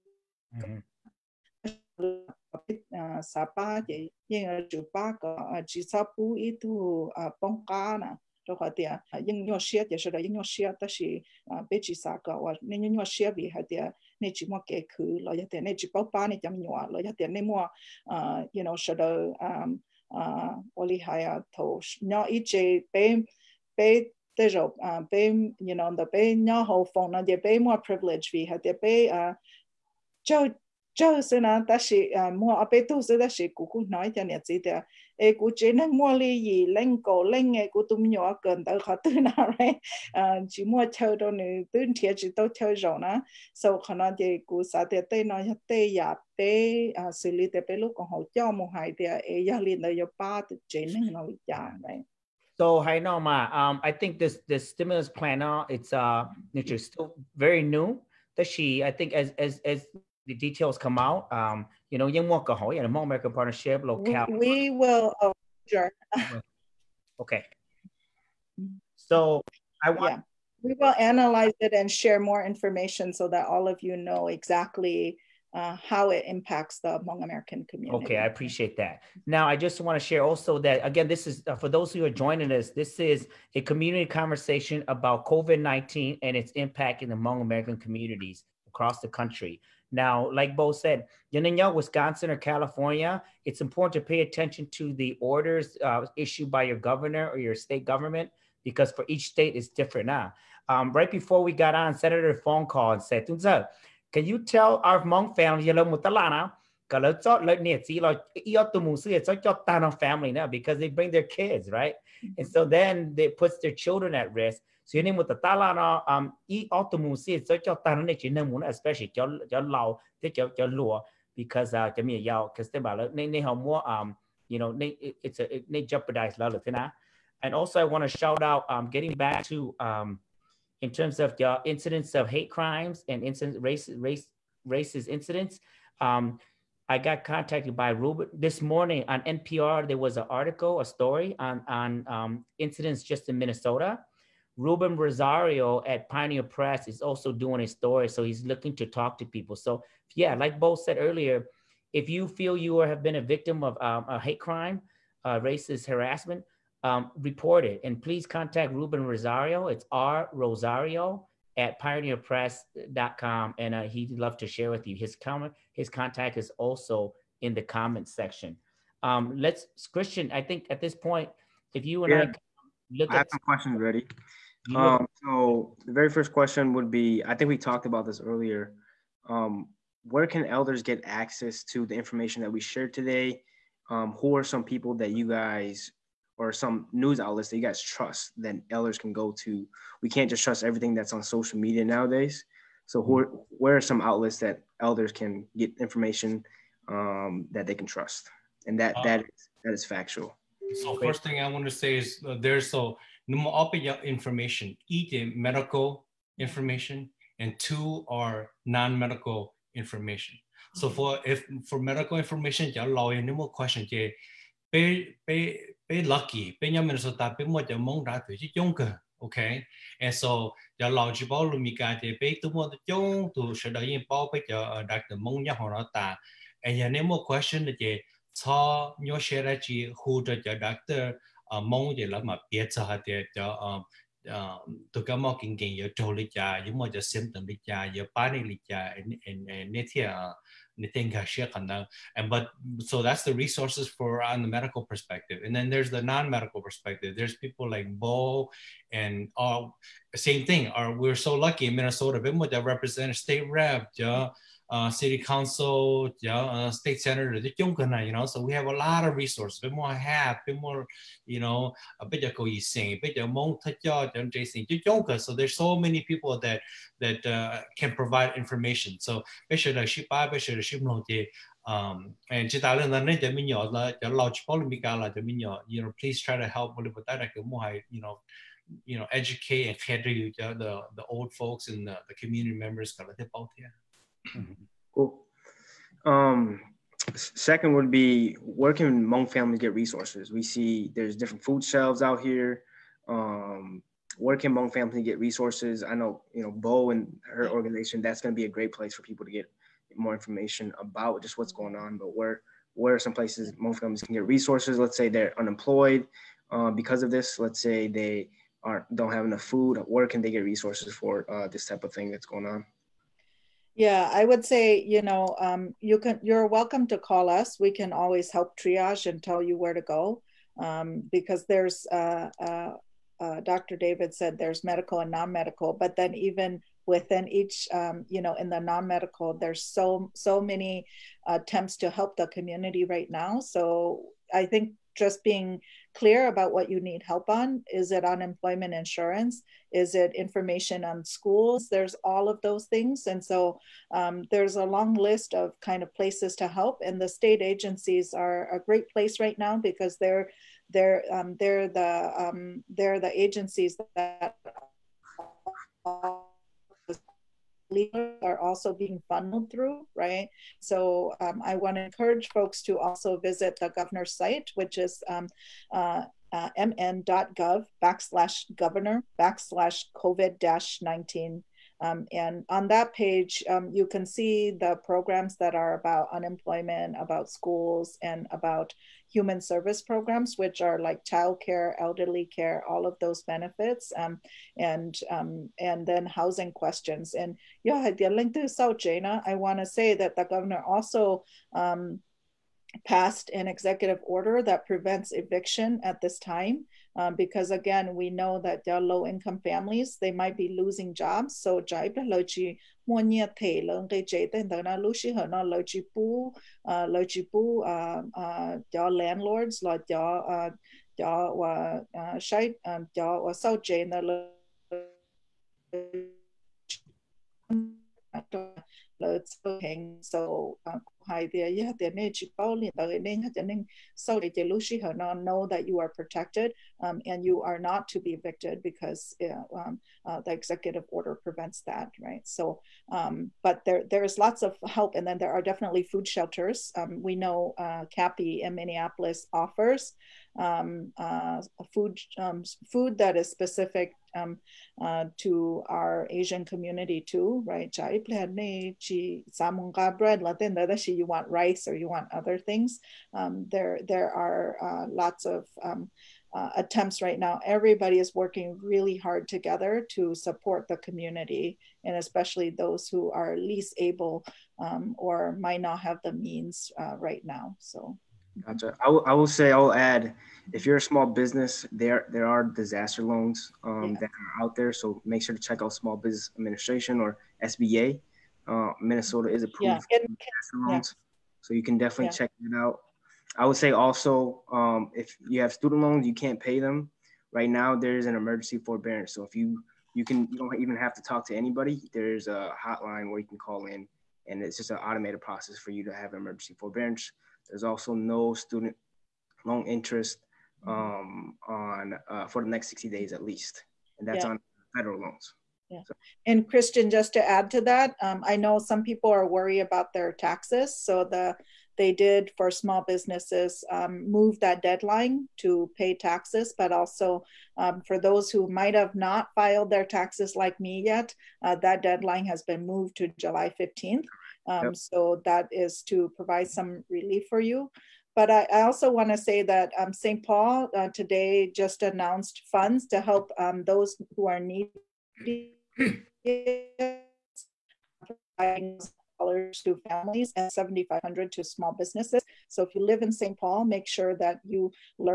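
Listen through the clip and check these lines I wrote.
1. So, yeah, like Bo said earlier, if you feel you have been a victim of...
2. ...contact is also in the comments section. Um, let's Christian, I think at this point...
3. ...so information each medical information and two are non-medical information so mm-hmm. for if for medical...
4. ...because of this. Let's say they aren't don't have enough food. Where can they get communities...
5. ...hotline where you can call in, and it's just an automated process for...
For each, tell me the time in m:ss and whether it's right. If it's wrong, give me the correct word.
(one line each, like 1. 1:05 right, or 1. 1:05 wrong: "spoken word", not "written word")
1. 2:29 right
2. 2:45 right
3. 3:22 right
4. 5:06 wrong: "resources", not "communities"
5. 8:12 right.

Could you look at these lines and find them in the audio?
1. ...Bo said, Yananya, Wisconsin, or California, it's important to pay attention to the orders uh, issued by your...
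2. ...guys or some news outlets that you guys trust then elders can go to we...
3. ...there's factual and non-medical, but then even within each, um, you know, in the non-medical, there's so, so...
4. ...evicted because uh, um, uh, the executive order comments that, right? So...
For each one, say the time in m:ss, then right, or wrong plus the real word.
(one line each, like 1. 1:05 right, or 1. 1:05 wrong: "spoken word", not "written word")
1. 1:30 right
2. 3:05 right
3. 5:24 wrong: "medical", not "factual"
4. 7:08 wrong: "prevents", not "comments".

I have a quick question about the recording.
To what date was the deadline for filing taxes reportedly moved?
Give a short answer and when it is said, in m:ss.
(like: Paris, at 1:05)
July 15th, at 8:43.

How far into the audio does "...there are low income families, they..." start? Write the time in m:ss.
6:38.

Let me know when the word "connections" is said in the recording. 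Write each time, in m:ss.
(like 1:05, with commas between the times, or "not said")
not said.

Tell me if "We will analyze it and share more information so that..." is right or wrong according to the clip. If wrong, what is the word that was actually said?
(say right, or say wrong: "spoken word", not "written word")
right.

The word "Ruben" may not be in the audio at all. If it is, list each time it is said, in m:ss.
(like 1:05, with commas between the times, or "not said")
2:17, 2:24, 2:38.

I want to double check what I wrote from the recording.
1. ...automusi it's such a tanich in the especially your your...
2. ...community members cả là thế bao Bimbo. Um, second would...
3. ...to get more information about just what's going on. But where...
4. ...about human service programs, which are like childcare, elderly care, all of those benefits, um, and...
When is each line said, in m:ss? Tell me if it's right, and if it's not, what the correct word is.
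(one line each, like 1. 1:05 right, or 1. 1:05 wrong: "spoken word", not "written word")
1. 1:56 right
2. 4:42 wrong: "Cool", not "Bimbo"
3. 4:59 right
4. 6:18 right.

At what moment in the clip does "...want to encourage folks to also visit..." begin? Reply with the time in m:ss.
6:01.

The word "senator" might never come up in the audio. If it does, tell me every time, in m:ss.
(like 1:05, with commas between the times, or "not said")
1:41, 4:16.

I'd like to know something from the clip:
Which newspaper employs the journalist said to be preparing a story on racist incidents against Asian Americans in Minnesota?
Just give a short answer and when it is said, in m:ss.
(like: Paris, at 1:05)
Pioneer Press, at 2:26.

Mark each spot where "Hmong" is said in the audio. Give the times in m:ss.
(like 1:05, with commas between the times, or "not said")
1:02, 1:16, 1:27, 1:45, 4:49, 4:54, 5:03.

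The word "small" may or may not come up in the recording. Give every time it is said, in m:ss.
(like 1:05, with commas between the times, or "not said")
7:50, 7:55, 8:32, 9:01.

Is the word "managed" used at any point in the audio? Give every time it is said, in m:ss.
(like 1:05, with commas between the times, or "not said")
not said.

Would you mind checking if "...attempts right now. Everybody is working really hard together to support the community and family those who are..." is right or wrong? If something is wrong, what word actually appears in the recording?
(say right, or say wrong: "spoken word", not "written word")
wrong: "especially", not "family".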